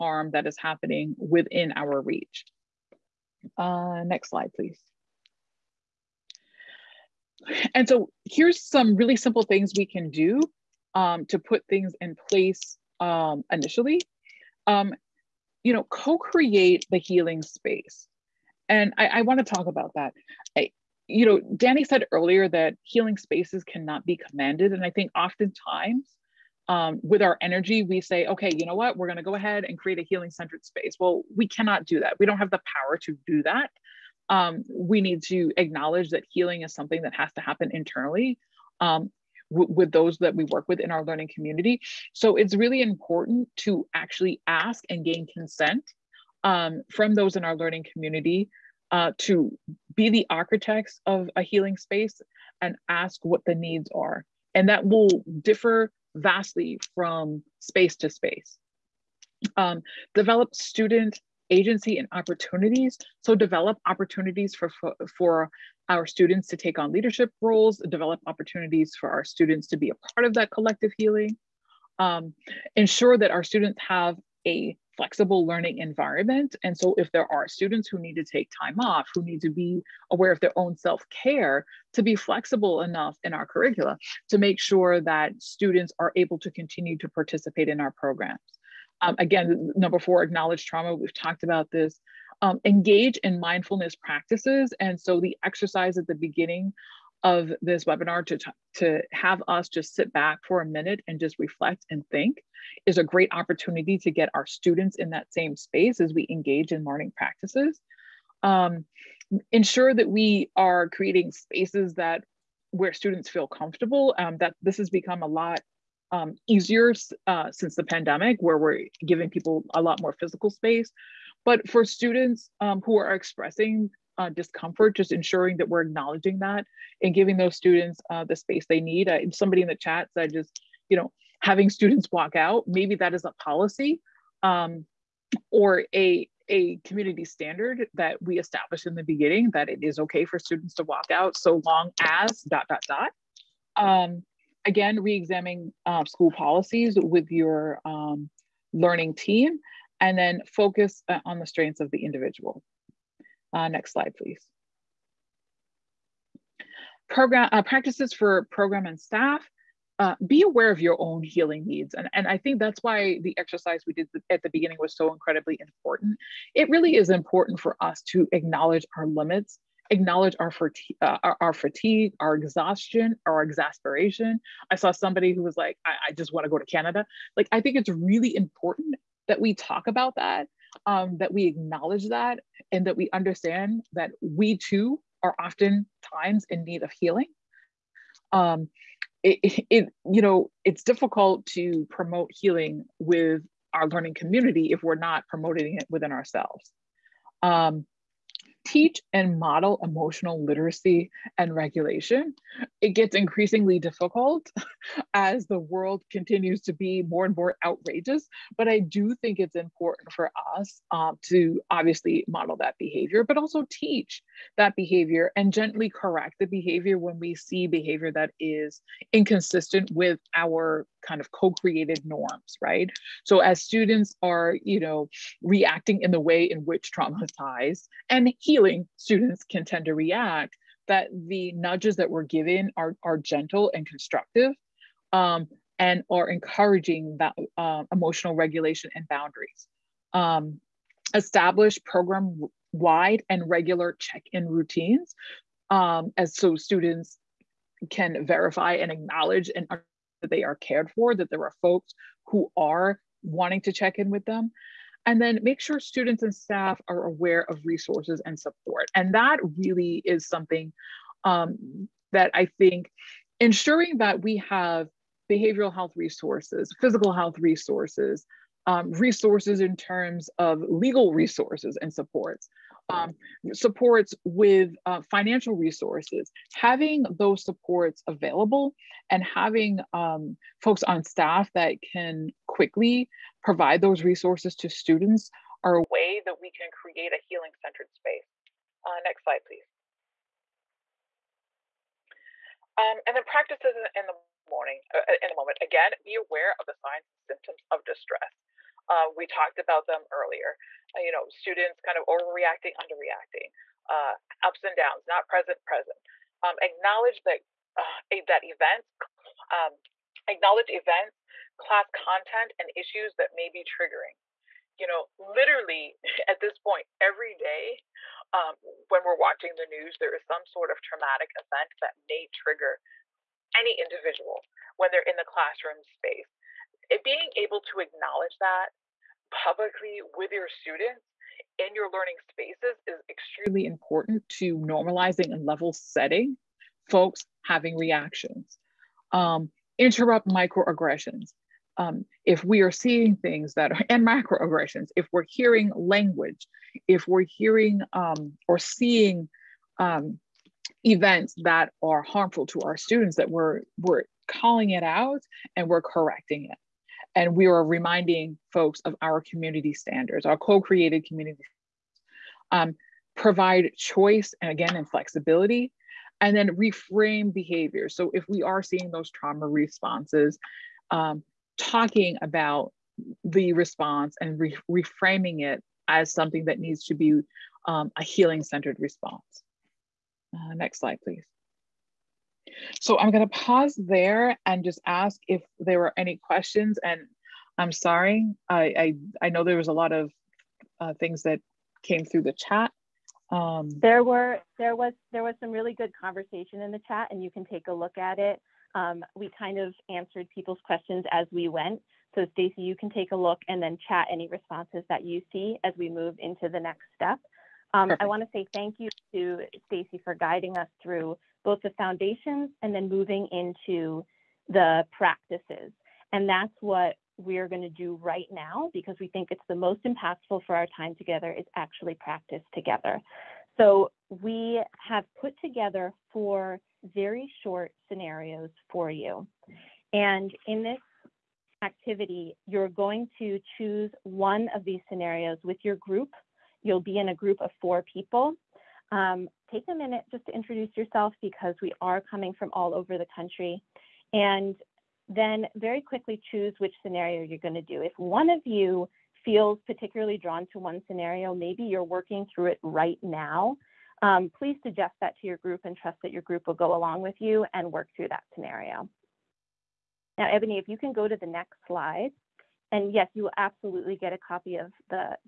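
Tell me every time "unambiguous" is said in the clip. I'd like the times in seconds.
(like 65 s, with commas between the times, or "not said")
not said.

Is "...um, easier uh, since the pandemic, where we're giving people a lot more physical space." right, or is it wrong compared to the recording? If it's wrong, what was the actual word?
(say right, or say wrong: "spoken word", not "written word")
right.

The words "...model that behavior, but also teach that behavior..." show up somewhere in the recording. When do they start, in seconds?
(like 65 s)
212 s.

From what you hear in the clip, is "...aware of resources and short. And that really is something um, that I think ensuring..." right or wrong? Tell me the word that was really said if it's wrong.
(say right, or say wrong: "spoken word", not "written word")
wrong: "support", not "short".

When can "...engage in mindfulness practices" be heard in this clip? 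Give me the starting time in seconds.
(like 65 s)
92 s.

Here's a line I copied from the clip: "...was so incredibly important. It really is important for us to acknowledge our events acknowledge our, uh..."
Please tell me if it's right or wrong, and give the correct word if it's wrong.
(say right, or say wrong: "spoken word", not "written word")
wrong: "limits", not "events".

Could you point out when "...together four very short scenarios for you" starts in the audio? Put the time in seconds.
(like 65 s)
425 s.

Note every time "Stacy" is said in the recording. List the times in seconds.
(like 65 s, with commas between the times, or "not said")
402 s, 409 s.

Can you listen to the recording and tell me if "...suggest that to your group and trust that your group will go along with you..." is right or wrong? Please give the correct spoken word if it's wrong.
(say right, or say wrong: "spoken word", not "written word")
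right.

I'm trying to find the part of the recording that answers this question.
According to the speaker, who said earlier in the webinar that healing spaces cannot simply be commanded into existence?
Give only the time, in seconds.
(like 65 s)
21 s.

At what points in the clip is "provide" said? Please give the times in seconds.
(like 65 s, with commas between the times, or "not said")
283 s, 363 s.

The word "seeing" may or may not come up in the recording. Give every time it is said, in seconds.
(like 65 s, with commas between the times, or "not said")
342 s, 348 s, 368 s.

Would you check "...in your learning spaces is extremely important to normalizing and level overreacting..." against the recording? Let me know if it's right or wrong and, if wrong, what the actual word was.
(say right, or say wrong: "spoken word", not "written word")
wrong: "setting", not "overreacting".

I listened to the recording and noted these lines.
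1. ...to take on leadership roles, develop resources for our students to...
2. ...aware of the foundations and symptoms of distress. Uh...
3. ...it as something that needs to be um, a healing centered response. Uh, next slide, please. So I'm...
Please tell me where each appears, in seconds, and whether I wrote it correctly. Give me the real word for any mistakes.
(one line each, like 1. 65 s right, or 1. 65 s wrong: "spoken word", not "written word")
1. 66 s wrong: "opportunities", not "resources"
2. 296 s wrong: "signs", not "foundations"
3. 375 s right.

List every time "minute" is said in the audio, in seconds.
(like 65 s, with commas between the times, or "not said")
100 s, 439 s.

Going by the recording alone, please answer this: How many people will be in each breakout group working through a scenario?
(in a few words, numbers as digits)
4.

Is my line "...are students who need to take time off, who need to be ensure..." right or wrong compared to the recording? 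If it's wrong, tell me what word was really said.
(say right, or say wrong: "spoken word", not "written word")
wrong: "aware", not "ensure".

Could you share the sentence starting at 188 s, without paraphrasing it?
Um, it, it, you know, it's difficult to promote healing with our learning community if we're not promoting it within ourselves.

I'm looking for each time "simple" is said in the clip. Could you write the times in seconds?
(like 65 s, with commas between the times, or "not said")
9 s.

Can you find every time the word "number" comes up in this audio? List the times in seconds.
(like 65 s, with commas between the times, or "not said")
89 s.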